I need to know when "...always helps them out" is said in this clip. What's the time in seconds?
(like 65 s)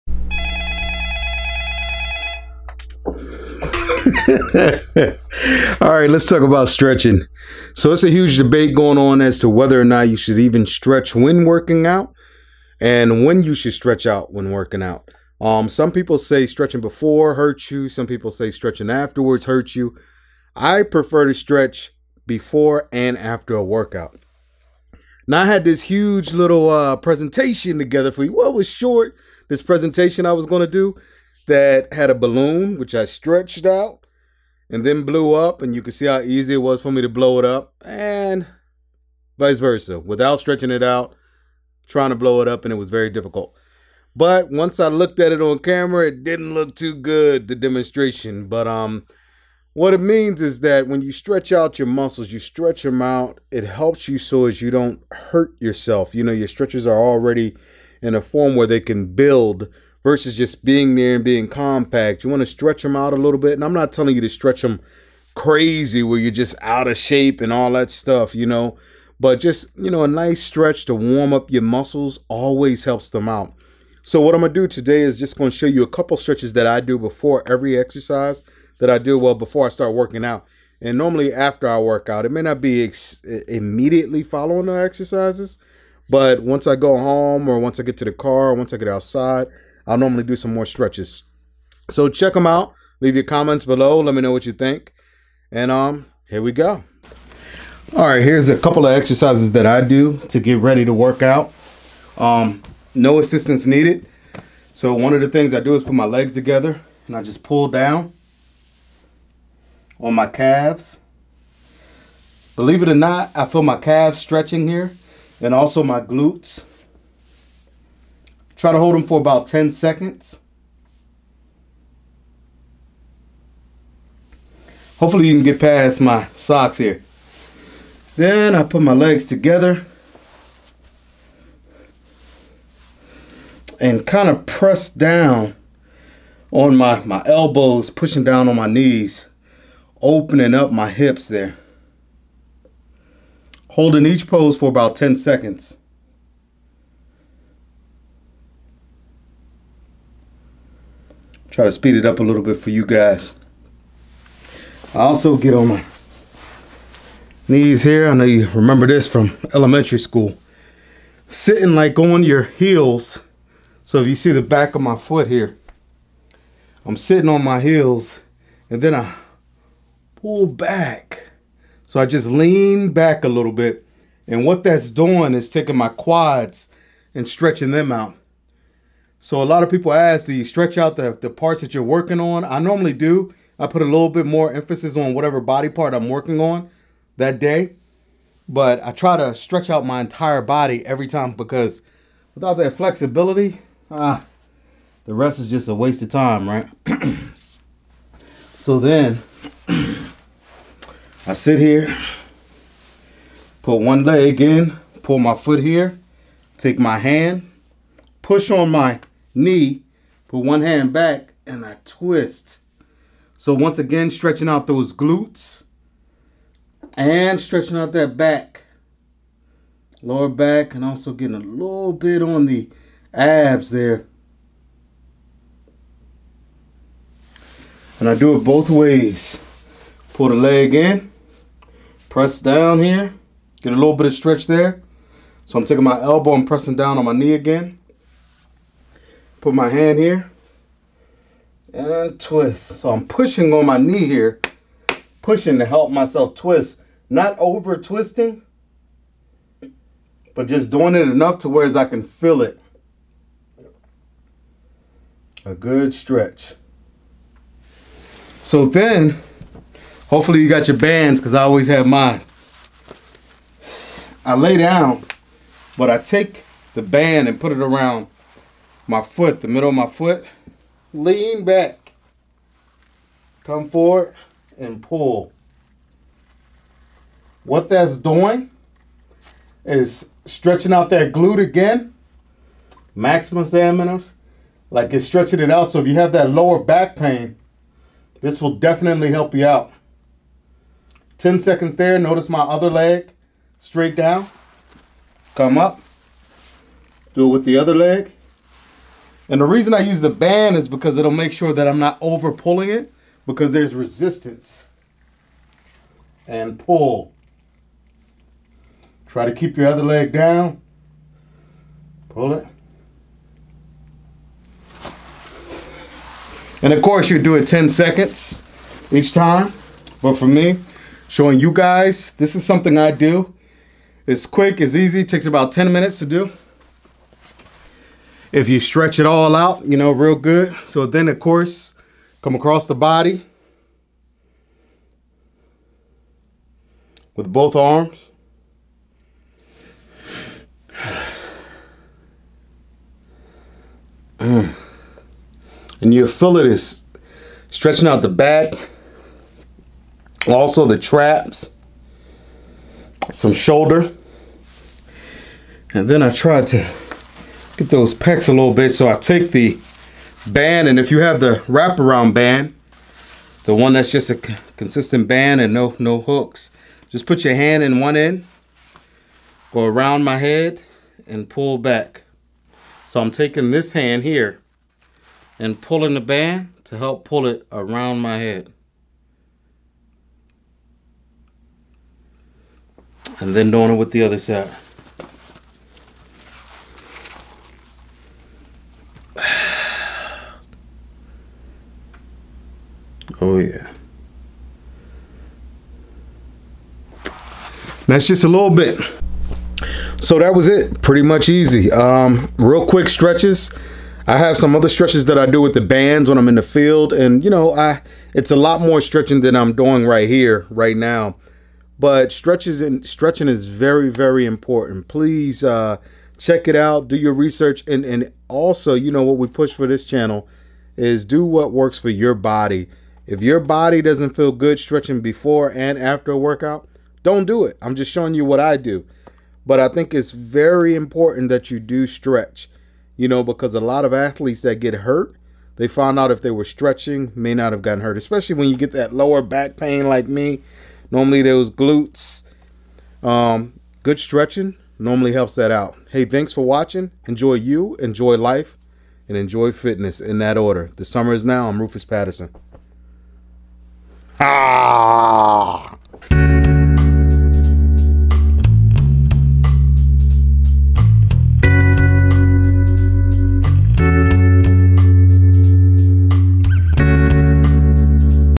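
72 s.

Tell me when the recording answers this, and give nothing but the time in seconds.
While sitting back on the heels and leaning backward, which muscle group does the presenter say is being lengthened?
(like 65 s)
175 s.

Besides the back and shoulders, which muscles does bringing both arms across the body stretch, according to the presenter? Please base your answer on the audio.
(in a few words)
Traps.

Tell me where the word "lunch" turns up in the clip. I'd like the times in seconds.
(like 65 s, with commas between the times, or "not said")
not said.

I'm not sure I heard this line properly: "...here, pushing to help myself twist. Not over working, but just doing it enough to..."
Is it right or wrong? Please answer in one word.
wrong.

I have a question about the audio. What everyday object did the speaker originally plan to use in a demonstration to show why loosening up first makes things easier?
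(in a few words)
A balloon.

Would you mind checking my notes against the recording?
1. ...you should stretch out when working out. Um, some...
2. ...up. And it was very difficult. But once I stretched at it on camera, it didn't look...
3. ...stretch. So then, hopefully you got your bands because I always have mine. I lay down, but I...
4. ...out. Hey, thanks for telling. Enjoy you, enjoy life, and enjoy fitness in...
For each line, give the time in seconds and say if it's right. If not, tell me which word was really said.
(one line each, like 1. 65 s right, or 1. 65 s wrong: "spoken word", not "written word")
1. 13 s right
2. 42 s wrong: "looked", not "stretched"
3. 255 s right
4. 445 s wrong: "watching", not "telling".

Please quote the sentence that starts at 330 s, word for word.
So then of course, come across the body with both arms.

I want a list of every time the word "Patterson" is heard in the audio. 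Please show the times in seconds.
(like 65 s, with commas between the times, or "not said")
451 s.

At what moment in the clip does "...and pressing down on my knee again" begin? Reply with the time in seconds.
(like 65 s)
236 s.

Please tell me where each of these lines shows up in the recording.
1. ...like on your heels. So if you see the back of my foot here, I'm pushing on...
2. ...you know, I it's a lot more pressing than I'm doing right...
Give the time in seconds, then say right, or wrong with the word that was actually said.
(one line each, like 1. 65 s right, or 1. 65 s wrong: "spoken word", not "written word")
1. 161 s wrong: "sitting", not "pushing"
2. 407 s wrong: "stretching", not "pressing".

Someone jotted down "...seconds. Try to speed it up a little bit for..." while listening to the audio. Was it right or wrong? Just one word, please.
right.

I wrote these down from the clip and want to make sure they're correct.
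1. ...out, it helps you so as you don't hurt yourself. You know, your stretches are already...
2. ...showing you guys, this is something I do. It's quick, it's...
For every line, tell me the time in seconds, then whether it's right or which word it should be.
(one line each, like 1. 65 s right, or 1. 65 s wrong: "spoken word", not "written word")
1. 53 s right
2. 321 s right.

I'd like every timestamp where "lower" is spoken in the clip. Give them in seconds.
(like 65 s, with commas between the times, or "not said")
220 s, 286 s, 438 s.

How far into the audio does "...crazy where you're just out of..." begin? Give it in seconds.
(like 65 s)
65 s.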